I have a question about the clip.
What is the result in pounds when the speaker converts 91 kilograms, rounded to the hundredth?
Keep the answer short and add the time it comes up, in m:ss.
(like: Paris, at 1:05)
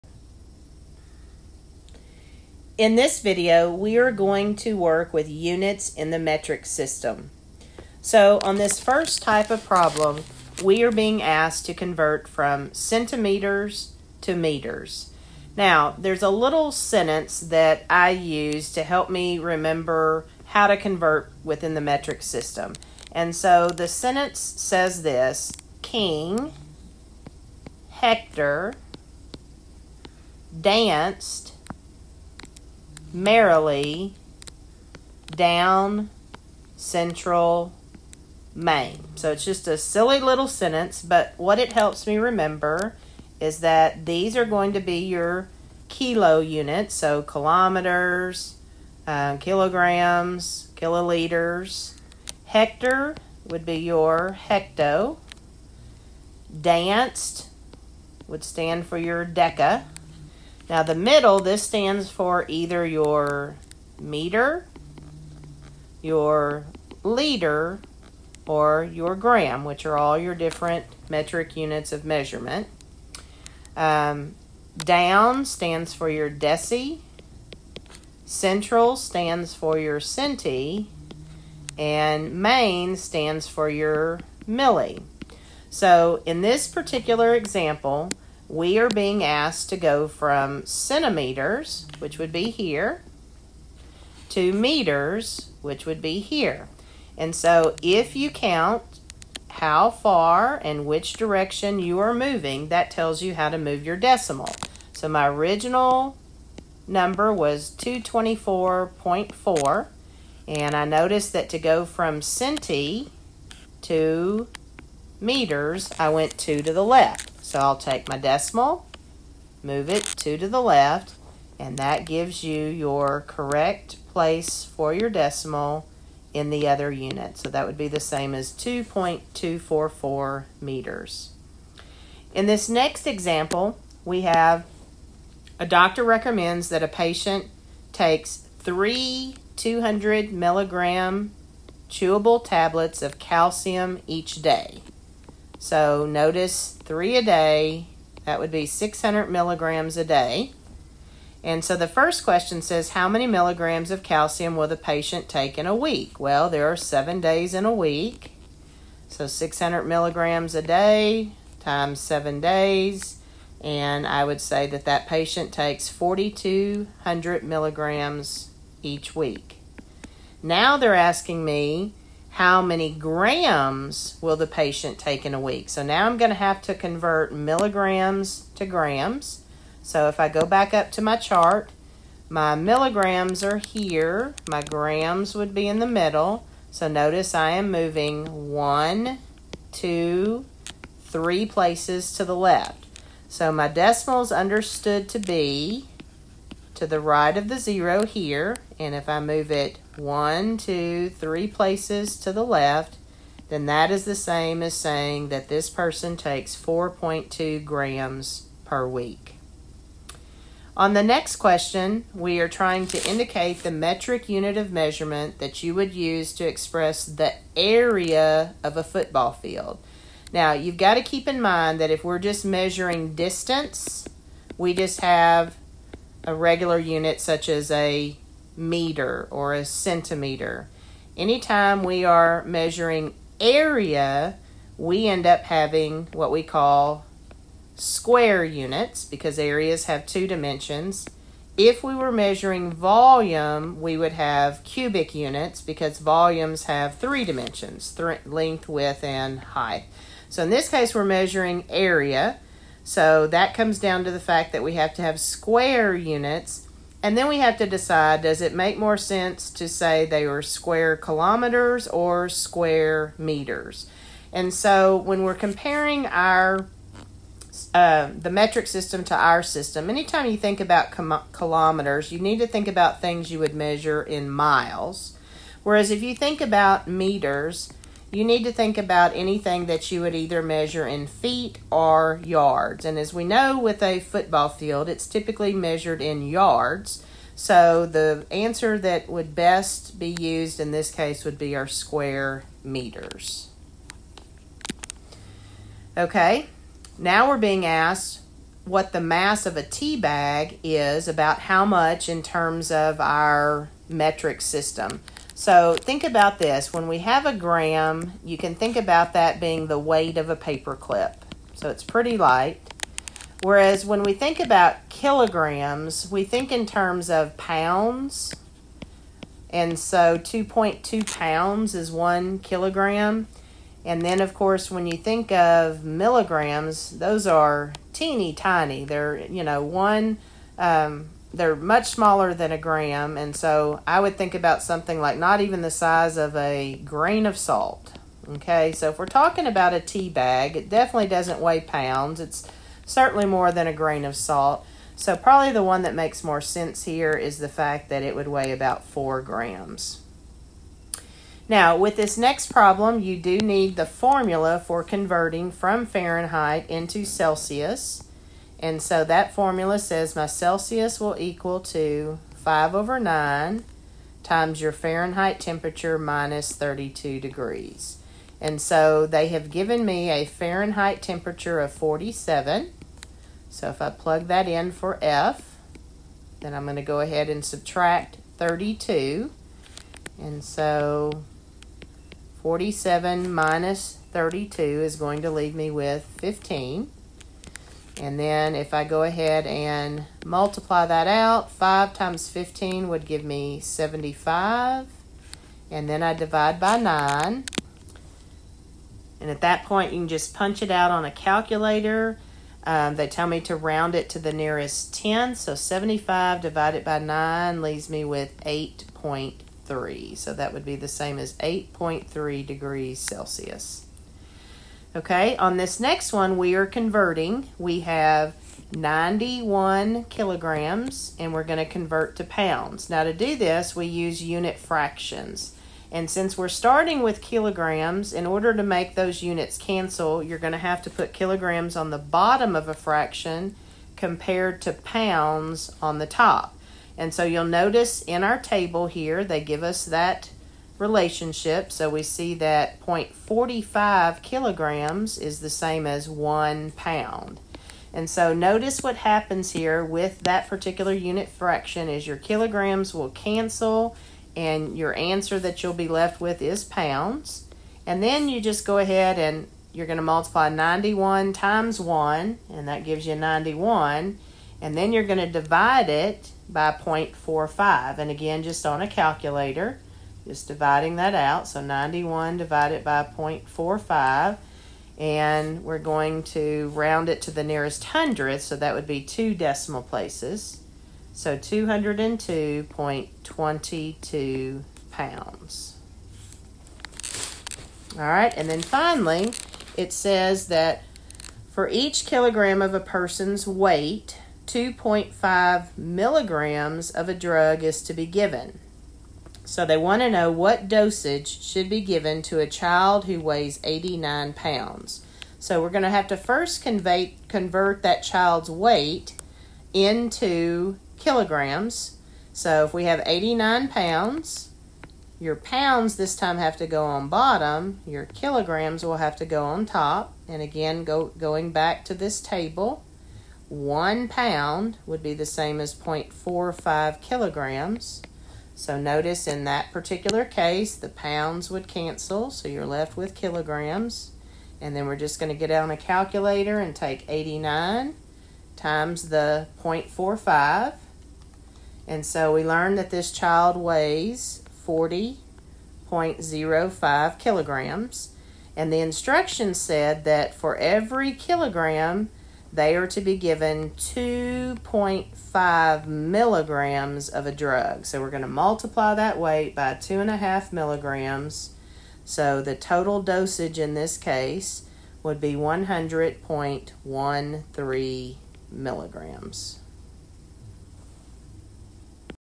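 202.22 pounds, at 8:01.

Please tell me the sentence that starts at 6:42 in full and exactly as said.
Um, they tell me to round it to the nearest 10.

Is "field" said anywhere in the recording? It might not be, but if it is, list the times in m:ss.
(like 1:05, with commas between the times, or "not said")
3:39, 4:44.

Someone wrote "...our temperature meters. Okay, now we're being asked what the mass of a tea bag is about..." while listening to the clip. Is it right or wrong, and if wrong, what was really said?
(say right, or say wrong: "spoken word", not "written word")
wrong: "square", not "temperature".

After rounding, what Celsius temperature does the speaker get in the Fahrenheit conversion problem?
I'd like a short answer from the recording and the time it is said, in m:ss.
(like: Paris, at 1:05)
8.3 degrees Celsius, at 6:51.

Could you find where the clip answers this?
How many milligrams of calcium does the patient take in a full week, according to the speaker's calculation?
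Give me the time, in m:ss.
2:45.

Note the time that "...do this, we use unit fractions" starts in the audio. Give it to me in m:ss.
7:03.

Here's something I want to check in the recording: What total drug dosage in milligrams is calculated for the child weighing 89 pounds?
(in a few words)
100.13 milligrams.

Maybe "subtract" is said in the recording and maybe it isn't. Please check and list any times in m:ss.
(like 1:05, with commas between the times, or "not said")
6:17.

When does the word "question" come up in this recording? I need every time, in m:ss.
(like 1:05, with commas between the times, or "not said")
2:32, 3:31.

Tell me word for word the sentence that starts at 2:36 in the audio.
Well, there are seven days in a week.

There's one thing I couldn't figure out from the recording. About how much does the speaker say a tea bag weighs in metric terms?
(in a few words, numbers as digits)
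4 grams.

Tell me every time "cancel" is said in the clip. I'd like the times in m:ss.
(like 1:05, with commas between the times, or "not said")
7:09, 7:33, 8:51.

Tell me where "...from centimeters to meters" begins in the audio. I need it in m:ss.
0:12.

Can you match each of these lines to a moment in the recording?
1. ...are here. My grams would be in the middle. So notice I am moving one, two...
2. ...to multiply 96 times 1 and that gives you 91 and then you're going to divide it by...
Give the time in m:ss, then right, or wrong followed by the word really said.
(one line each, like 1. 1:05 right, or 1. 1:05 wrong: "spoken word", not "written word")
1. 3:03 right
2. 7:39 wrong: "91", not "96".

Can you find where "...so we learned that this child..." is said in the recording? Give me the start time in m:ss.
9:02.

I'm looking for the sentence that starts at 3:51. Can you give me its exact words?
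Anytime we are measuring area, we end up having what we call square units because areas have two dimensions.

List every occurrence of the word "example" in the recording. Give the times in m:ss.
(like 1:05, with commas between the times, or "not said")
1:27, 2:13.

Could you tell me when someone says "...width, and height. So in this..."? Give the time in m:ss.
4:08.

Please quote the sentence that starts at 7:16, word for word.
And so you'll notice in our table here, they give us that relationship.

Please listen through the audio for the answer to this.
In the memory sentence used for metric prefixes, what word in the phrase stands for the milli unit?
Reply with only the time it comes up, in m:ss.
1:22.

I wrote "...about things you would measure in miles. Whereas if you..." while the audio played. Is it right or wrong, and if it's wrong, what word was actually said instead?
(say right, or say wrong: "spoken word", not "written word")
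right.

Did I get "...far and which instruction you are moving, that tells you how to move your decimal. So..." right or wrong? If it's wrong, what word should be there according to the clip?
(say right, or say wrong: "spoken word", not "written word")
wrong: "direction", not "instruction".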